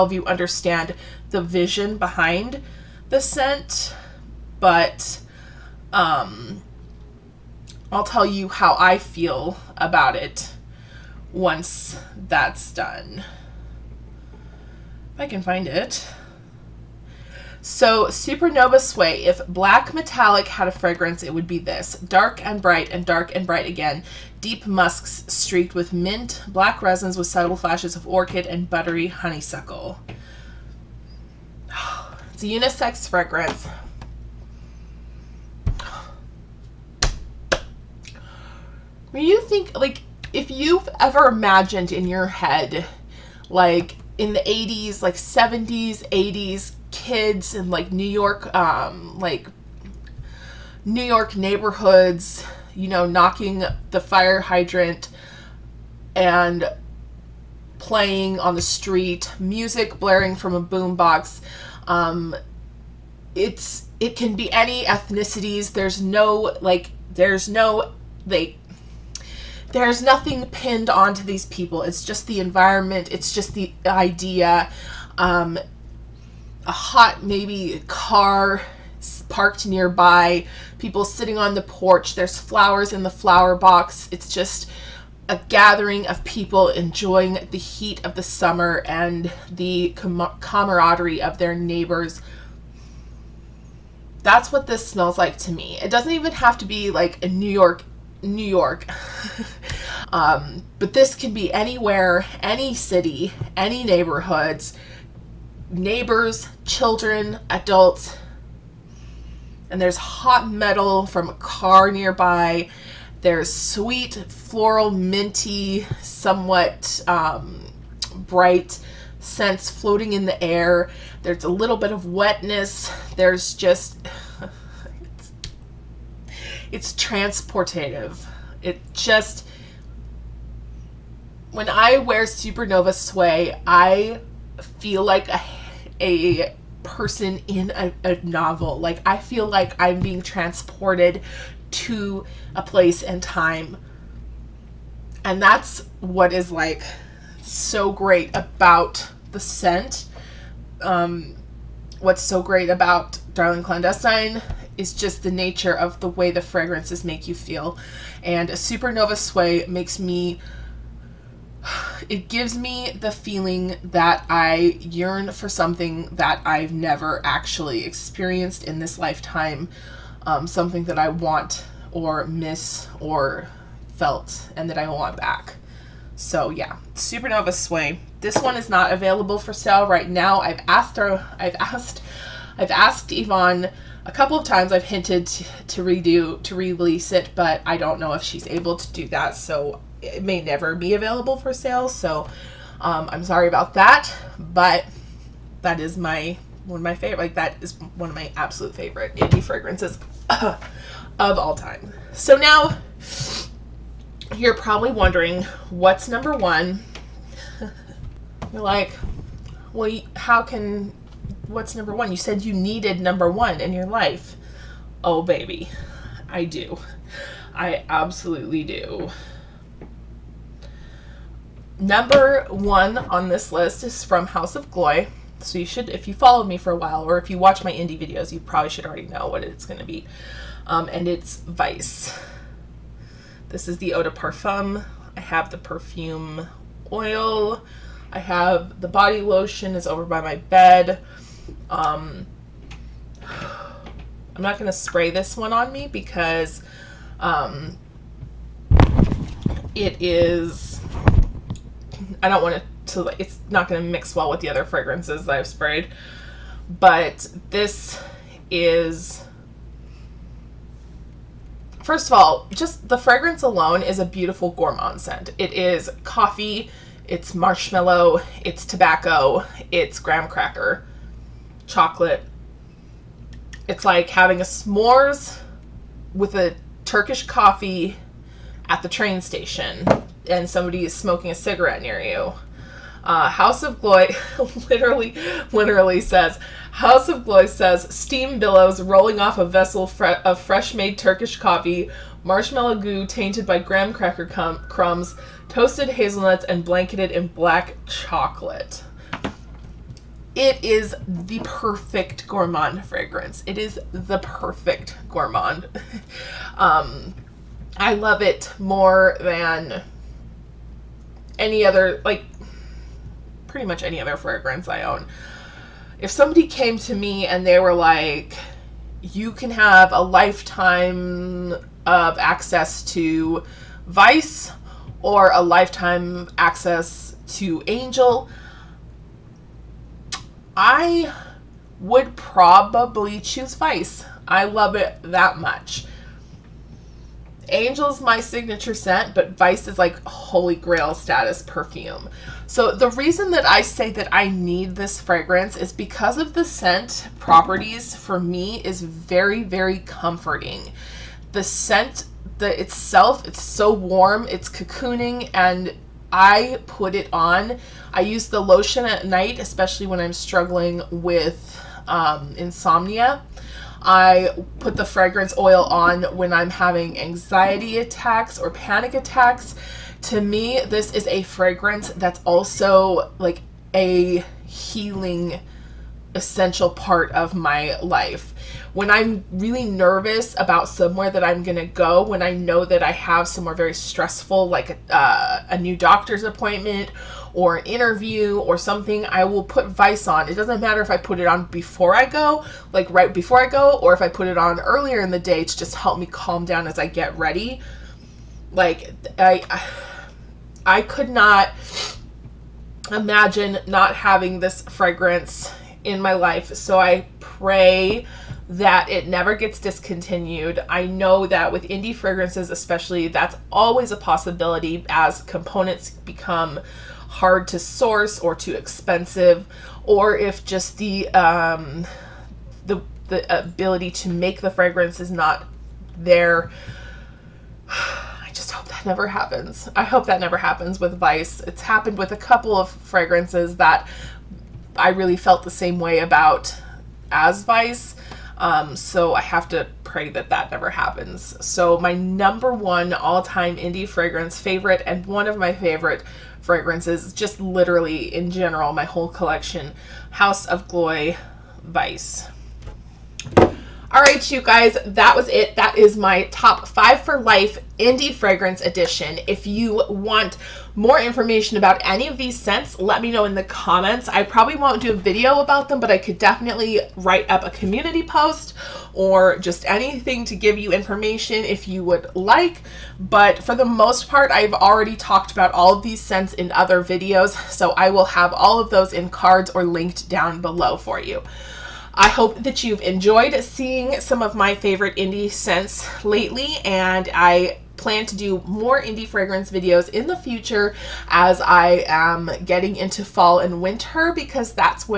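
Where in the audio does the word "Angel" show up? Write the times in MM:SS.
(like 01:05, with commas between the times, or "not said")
05:27, 05:37.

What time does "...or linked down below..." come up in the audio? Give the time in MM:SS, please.
07:59.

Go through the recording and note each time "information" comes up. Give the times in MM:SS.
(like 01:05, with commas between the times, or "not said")
07:41, 07:50.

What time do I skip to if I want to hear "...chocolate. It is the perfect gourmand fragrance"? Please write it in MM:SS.
04:57.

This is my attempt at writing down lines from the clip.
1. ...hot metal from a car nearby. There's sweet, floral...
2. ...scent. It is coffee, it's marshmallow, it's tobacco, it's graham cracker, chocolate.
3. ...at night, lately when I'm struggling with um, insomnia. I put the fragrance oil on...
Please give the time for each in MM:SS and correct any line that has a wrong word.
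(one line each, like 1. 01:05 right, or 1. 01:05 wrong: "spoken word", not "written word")
1. 01:49 right
2. 04:25 right
3. 05:58 wrong: "especially", not "lately".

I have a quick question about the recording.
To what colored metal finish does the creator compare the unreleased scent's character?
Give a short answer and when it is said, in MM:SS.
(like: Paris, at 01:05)
black metallic, at 00:19.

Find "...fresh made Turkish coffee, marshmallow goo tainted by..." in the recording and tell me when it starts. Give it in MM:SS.
04:50.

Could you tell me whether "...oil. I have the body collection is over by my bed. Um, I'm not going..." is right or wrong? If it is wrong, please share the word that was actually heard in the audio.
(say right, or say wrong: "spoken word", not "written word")
wrong: "lotion", not "collection".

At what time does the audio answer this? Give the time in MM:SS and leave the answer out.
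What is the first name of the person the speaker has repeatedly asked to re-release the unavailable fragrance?
03:03.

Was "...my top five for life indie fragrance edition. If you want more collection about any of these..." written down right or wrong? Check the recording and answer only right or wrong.
wrong.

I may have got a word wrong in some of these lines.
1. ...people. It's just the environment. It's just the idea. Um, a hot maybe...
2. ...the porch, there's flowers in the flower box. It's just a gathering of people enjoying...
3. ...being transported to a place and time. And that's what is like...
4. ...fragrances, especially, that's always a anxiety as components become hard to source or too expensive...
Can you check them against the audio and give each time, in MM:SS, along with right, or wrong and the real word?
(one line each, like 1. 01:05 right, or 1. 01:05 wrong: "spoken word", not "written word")
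1. 01:11 right
2. 01:21 right
3. 02:20 right
4. 06:51 wrong: "possibility", not "anxiety".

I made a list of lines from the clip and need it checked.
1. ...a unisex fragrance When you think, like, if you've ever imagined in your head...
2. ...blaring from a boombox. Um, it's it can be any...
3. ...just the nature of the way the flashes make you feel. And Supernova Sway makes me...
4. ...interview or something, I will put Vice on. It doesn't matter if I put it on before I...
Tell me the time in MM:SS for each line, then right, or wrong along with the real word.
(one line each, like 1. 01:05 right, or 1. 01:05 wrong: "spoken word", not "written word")
1. 00:32 right
2. 01:00 right
3. 02:34 wrong: "fragrances", not "flashes"
4. 06:27 right.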